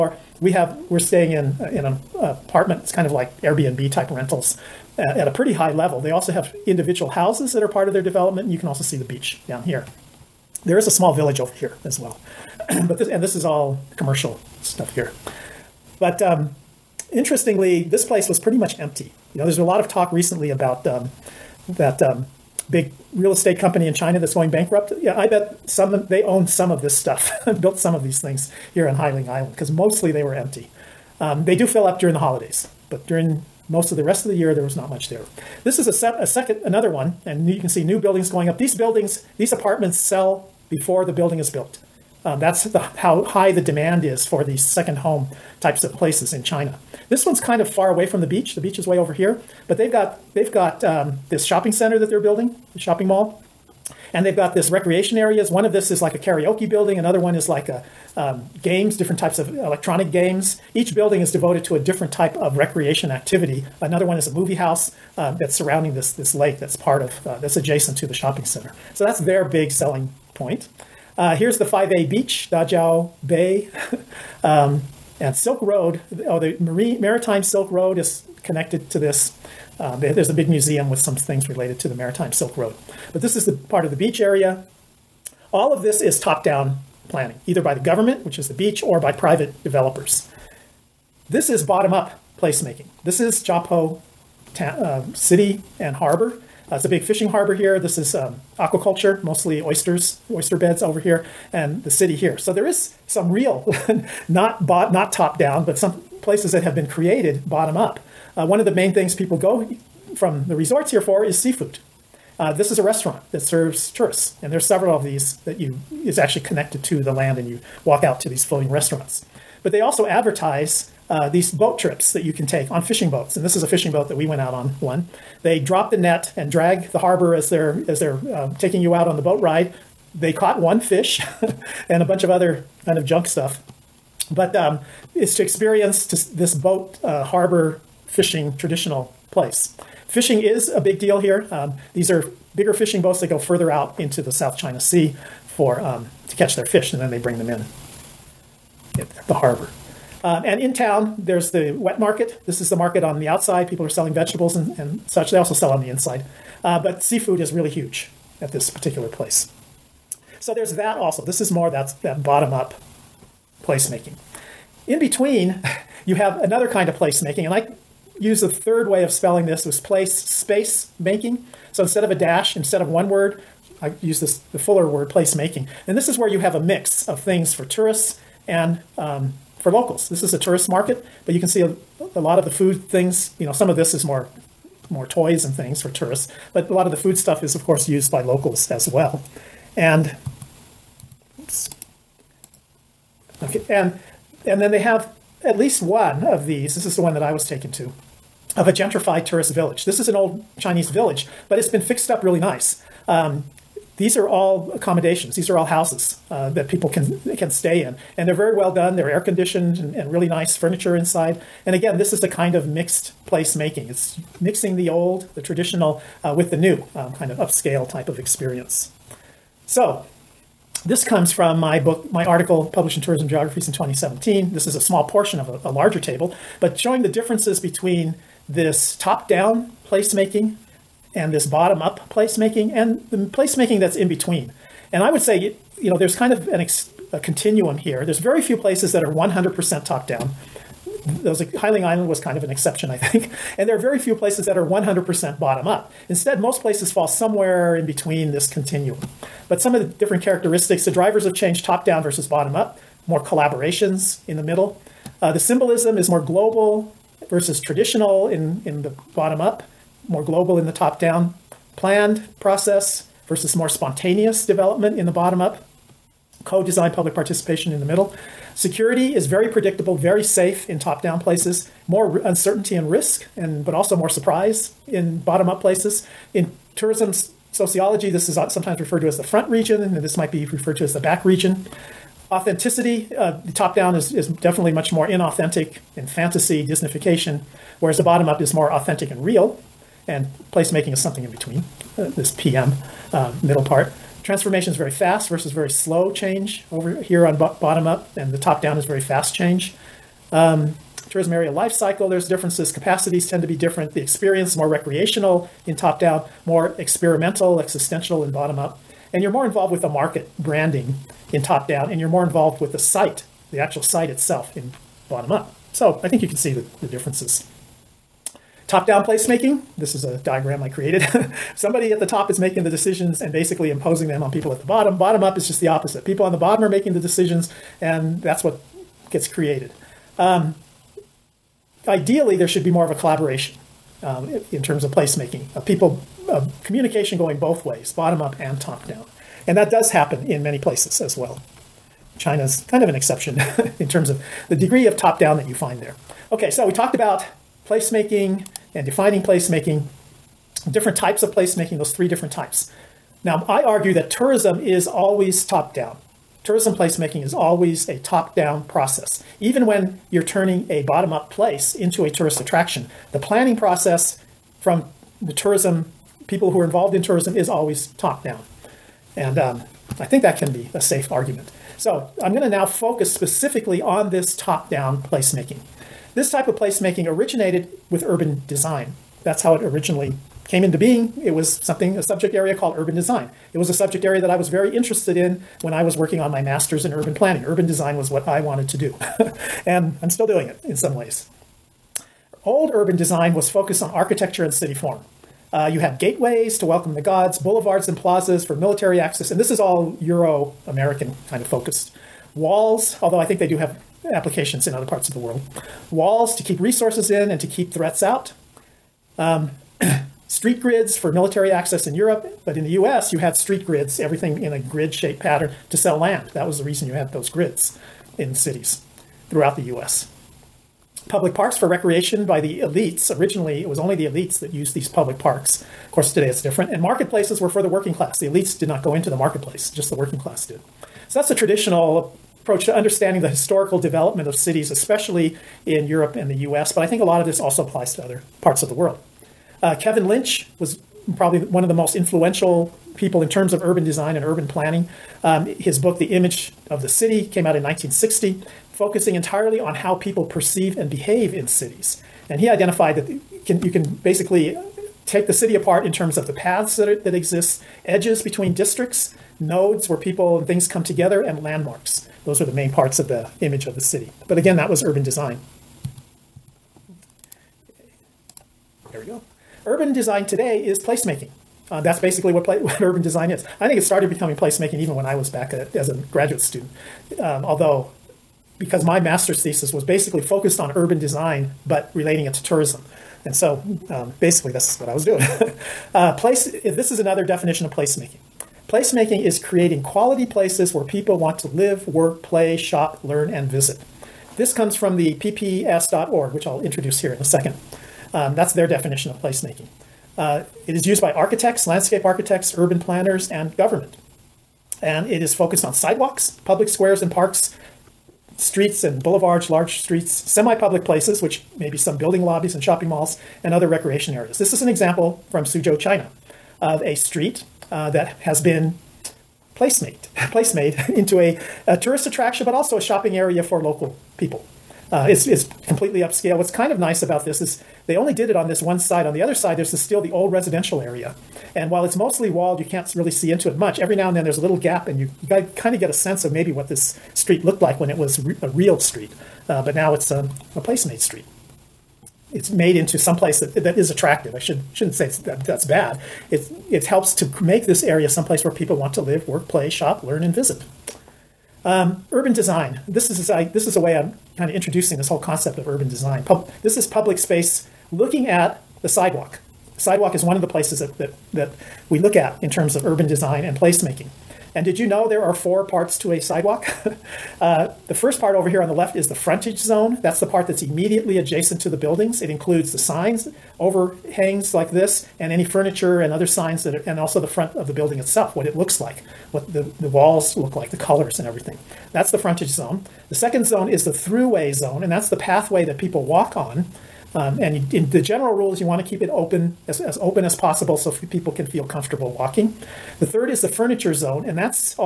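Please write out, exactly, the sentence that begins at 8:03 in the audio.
And so um, basically, that's what I was doing.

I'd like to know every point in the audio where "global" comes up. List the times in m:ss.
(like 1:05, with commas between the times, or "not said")
4:16, 4:20.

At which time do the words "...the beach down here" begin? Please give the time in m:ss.
0:08.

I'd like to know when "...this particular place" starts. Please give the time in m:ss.
2:38.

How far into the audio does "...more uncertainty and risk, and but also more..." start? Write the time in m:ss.
4:31.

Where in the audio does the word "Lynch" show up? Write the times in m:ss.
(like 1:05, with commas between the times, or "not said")
7:20.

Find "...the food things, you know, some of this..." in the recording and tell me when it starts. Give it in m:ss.
3:02.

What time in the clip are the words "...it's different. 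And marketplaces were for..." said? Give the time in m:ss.
7:06.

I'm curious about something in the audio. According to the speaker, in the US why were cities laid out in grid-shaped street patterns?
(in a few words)
to sell land.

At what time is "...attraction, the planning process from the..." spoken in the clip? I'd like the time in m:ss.
6:02.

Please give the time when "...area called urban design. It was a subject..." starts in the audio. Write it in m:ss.
6:22.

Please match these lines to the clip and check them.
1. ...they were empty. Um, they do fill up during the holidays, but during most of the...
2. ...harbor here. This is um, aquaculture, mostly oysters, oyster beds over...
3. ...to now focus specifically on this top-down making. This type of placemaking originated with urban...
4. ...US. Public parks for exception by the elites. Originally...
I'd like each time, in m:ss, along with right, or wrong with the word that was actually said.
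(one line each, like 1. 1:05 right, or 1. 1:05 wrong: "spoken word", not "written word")
1. 0:30 right
2. 1:37 right
3. 6:12 wrong: "placemaking", not "making"
4. 6:59 wrong: "recreation", not "exception".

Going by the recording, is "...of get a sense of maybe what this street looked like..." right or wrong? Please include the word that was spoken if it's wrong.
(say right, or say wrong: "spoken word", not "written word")
right.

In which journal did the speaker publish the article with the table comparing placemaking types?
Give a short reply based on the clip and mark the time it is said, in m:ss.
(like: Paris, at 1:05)
Tourism Geographies, at 3:43.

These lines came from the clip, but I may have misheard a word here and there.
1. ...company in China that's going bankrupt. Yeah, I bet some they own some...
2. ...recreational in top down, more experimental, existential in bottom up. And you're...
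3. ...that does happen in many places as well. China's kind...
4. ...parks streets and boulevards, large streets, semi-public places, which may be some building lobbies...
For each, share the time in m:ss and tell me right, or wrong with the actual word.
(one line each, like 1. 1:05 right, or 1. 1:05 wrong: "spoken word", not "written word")
1. 0:23 right
2. 5:04 right
3. 5:39 right
4. 8:27 right.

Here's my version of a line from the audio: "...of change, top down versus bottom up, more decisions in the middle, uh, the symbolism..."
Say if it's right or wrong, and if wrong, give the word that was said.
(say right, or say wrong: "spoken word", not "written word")
wrong: "collaborations", not "decisions".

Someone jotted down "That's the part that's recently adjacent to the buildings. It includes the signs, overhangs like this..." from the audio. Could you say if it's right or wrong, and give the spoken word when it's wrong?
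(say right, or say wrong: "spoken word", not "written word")
wrong: "immediately", not "recently".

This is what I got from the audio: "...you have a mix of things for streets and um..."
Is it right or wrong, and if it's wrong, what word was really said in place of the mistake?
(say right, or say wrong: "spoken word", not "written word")
wrong: "tourists", not "streets".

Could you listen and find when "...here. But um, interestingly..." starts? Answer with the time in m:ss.
0:14.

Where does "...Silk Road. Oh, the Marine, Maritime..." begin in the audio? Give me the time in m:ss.
1:15.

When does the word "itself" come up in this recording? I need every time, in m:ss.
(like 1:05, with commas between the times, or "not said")
5:14, 9:37.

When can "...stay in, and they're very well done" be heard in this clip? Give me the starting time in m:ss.
3:27.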